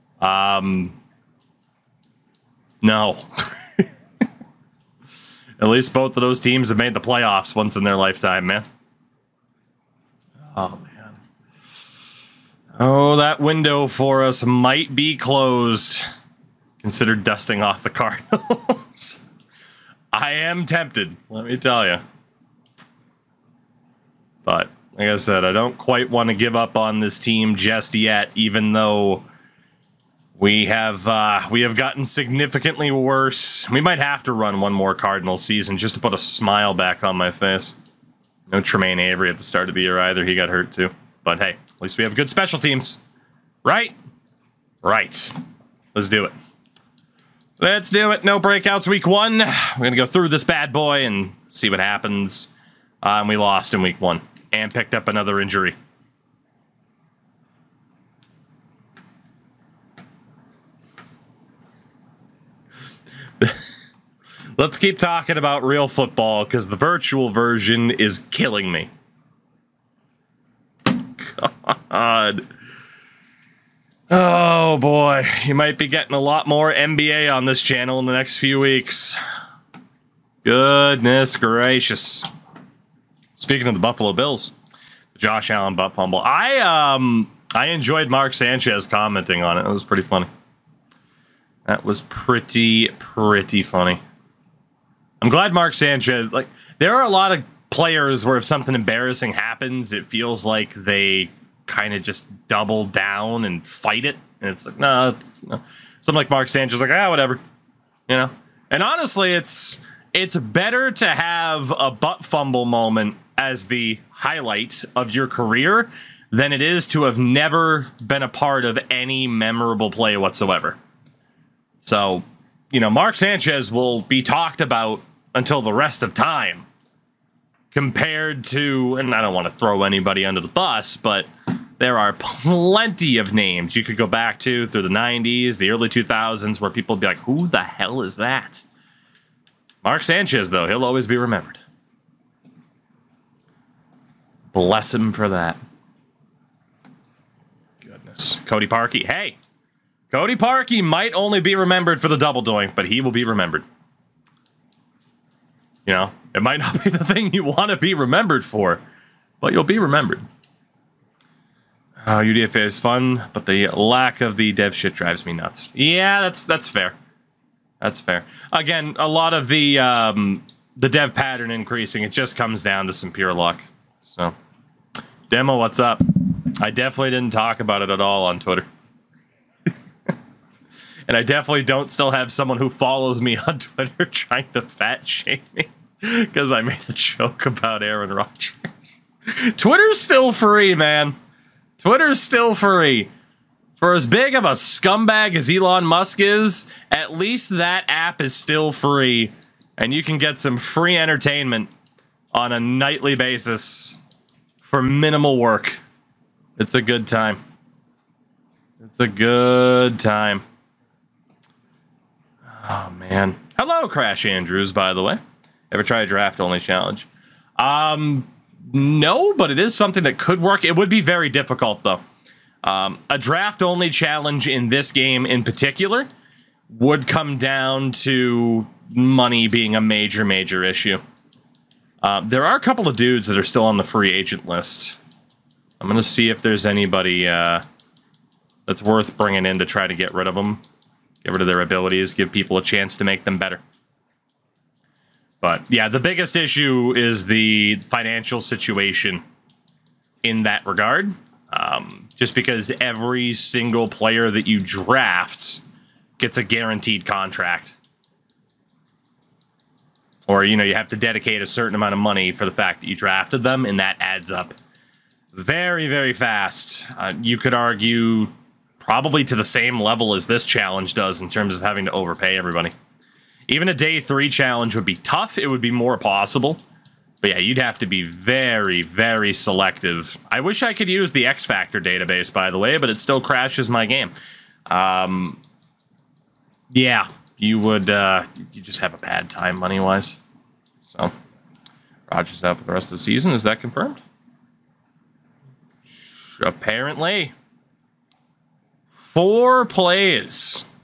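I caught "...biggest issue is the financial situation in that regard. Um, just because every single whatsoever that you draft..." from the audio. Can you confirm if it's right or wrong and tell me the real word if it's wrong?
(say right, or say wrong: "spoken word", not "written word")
wrong: "player", not "whatsoever".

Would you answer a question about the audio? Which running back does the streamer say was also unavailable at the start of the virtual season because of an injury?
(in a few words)
Tremaine Avery.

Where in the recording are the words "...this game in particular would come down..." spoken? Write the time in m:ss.
3:44.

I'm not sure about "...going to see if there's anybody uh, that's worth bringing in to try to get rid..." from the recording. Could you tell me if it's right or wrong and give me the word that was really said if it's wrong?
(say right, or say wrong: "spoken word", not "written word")
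right.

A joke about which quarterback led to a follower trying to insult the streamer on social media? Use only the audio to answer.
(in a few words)
Aaron Rodgers.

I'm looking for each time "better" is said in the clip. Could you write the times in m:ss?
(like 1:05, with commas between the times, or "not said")
1:50, 4:03.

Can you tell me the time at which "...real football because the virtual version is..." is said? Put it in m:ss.
1:05.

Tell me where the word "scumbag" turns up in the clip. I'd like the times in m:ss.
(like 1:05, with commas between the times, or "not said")
3:14.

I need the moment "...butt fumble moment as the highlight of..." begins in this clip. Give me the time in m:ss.
1:51.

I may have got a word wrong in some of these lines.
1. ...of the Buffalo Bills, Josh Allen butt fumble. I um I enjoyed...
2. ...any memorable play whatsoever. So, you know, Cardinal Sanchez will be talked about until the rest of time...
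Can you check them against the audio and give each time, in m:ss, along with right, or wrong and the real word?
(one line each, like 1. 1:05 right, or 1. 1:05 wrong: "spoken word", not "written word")
1. 1:23 right
2. 1:58 wrong: "Mark", not "Cardinal".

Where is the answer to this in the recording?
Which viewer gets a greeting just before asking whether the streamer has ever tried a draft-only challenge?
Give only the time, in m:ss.
3:33.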